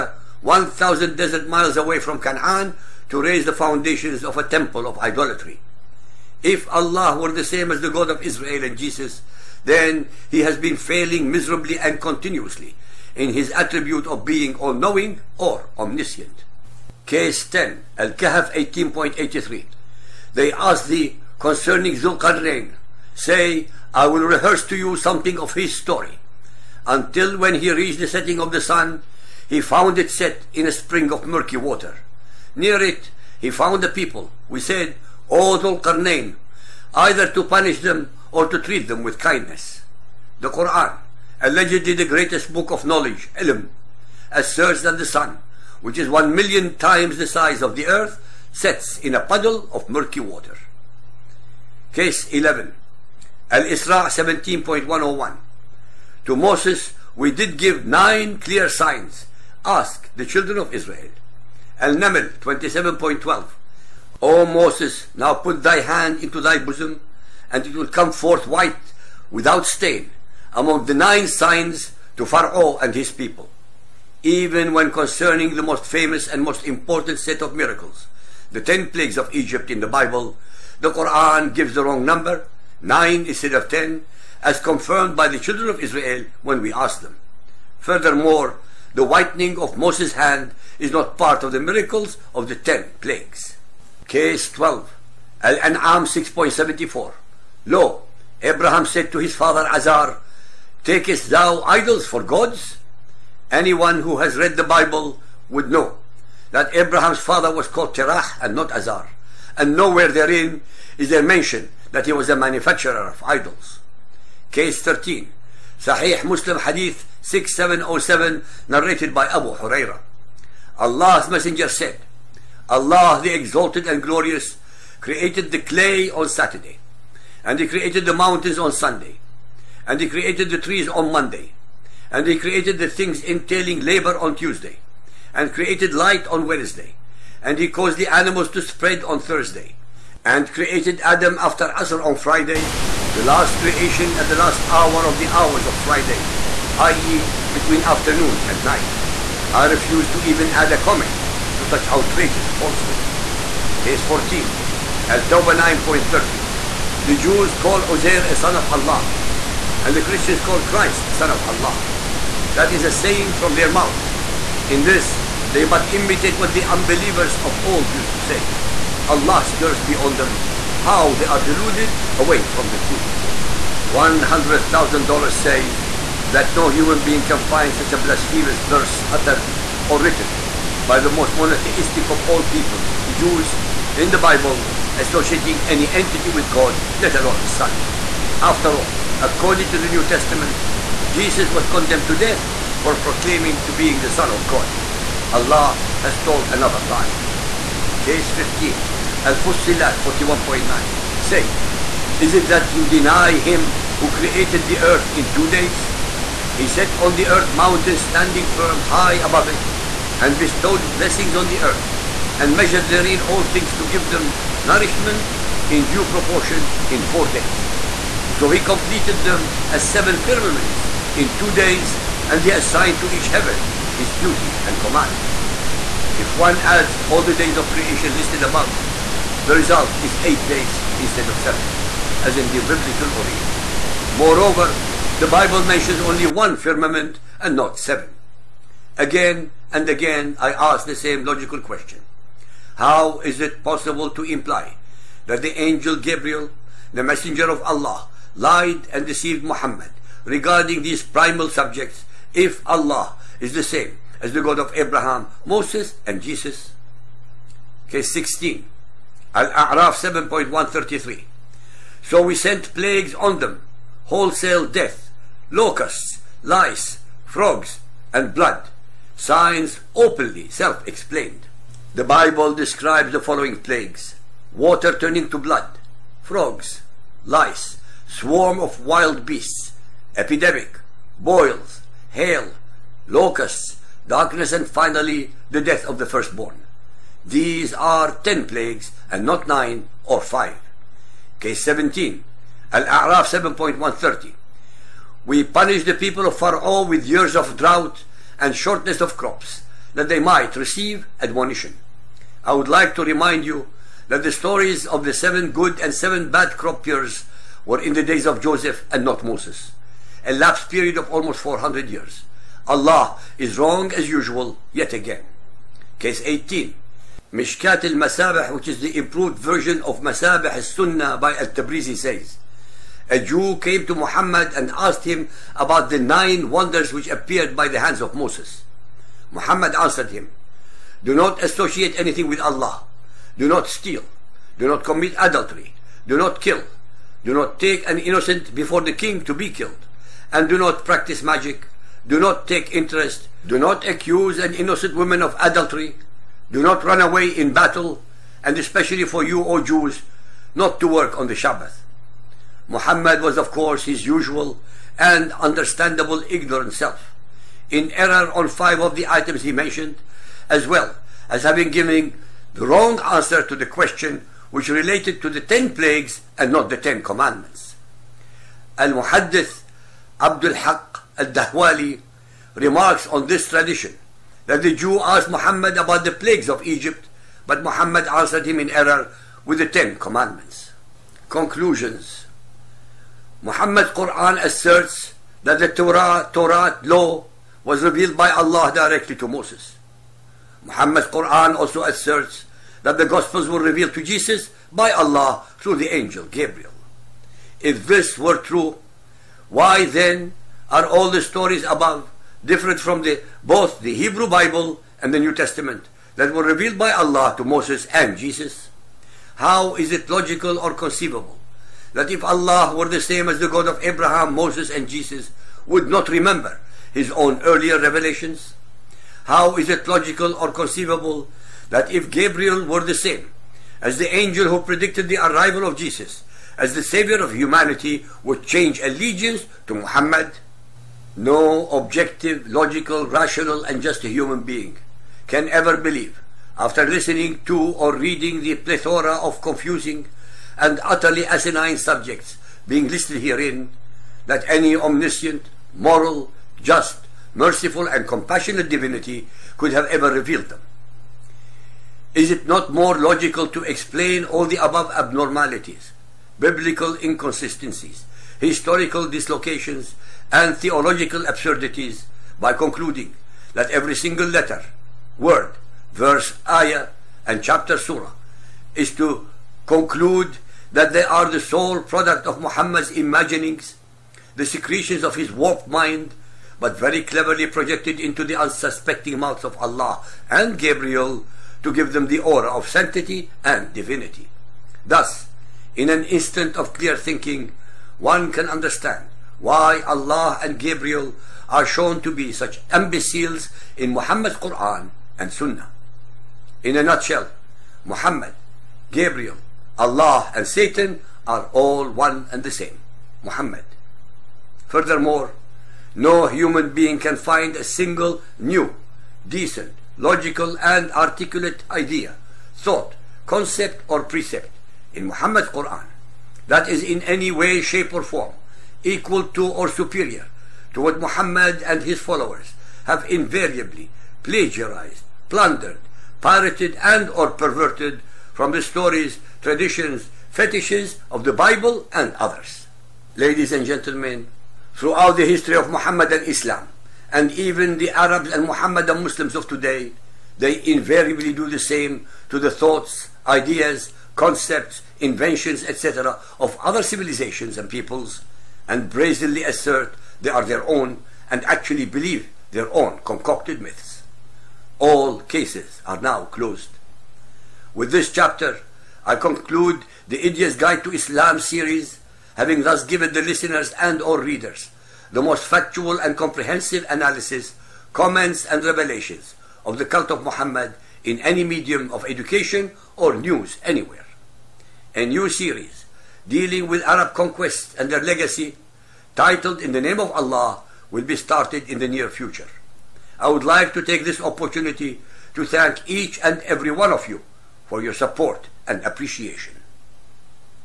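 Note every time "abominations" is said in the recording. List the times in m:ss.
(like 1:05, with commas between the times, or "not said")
not said.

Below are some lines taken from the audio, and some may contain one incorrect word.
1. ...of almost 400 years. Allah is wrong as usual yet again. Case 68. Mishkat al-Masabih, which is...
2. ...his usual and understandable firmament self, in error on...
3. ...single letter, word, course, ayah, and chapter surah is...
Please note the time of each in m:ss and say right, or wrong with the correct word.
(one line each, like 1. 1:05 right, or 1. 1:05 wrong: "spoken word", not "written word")
1. 5:10 wrong: "18", not "68"
2. 5:53 wrong: "ignorant", not "firmament"
3. 7:43 wrong: "verse", not "course".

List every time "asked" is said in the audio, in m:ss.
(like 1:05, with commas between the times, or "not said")
0:20, 5:24, 6:15.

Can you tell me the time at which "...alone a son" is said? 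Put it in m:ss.
3:07.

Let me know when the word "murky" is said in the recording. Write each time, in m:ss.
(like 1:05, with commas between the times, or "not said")
0:31, 0:49.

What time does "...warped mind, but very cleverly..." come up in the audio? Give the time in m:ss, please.
7:55.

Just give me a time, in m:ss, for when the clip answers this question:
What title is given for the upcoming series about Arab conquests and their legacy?
9:39.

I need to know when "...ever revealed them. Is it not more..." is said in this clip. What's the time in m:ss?
7:29.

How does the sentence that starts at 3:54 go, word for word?
Moreover, the Bible mentions only one firmament and not seven.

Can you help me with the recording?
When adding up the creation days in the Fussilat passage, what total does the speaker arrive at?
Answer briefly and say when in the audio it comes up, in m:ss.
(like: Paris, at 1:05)
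eight days, at 3:50.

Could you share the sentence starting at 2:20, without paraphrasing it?
And created Adam after Asr on Friday, the last creation at the last hour of the hours of Friday, i.e.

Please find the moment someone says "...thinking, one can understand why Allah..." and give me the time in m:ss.
8:06.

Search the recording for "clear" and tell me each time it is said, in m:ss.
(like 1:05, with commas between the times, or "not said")
0:58, 8:06.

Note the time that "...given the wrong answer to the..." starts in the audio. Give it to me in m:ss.
6:01.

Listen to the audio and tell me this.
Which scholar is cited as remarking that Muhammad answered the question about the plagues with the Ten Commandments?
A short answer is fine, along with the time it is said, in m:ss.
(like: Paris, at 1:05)
Abdul Haq al-Dahwali, at 6:10.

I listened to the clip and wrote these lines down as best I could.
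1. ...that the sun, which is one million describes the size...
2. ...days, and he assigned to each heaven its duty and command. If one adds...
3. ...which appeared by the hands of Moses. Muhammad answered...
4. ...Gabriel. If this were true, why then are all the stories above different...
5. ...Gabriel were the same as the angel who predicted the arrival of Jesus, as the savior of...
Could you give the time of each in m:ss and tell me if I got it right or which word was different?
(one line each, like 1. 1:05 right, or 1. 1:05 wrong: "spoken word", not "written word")
1. 0:44 wrong: "times", not "describes"
2. 3:41 right
3. 5:26 right
4. 6:36 right
5. 7:02 right.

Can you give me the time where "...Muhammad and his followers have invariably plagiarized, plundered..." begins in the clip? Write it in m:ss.
8:41.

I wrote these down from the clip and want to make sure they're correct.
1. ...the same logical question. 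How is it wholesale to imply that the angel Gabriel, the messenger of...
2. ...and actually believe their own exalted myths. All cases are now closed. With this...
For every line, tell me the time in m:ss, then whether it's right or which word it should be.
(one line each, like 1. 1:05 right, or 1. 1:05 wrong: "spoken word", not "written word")
1. 4:00 wrong: "possible", not "wholesale"
2. 9:11 wrong: "concocted", not "exalted".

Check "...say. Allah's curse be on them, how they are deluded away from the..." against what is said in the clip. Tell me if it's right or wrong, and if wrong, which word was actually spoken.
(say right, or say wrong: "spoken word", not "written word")
right.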